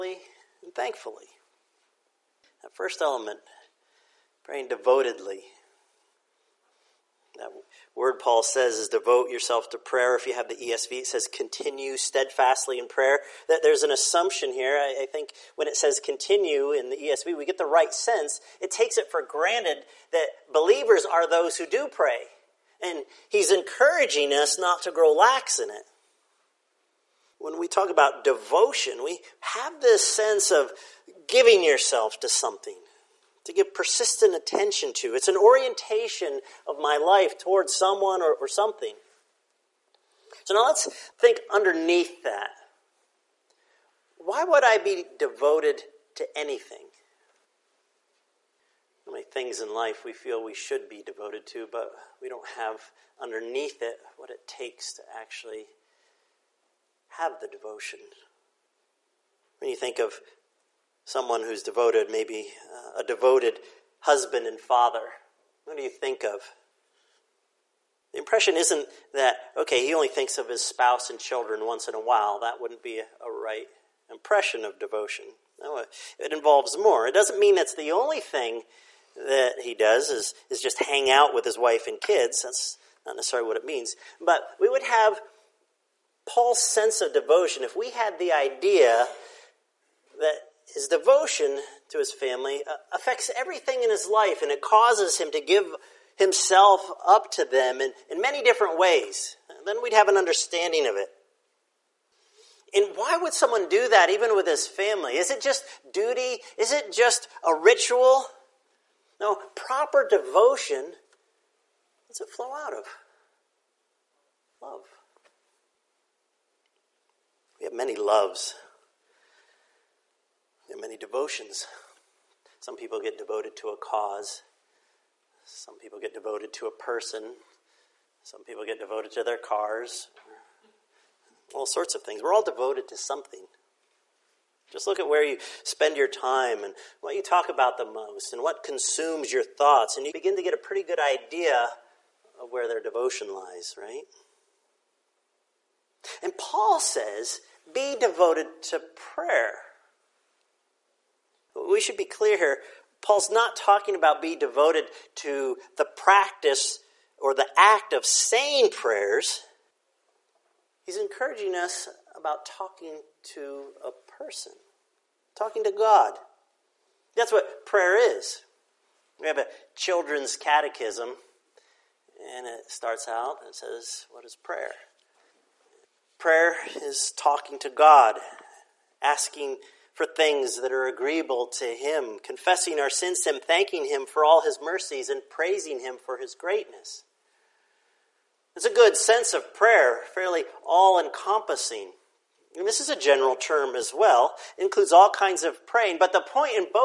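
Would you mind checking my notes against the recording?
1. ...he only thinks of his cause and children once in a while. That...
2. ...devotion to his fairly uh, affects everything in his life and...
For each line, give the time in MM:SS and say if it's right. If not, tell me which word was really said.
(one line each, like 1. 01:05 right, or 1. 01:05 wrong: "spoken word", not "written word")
1. 01:09 wrong: "spouse", not "cause"
2. 01:30 wrong: "family", not "fairly".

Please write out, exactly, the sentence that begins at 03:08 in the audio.
It's a good sense of prayer, fairly all encompassing.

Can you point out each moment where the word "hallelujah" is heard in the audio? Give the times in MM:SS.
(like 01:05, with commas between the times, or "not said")
not said.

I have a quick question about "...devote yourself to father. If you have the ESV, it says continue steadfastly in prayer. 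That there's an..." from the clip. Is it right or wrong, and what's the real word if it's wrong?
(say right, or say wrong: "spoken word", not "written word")
wrong: "prayer", not "father".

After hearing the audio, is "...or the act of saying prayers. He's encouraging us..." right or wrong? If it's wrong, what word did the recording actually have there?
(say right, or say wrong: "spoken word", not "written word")
right.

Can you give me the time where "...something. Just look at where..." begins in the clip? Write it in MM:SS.
02:12.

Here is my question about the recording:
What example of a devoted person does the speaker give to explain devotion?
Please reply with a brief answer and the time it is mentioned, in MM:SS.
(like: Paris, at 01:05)
A devoted husband and father, at 01:03.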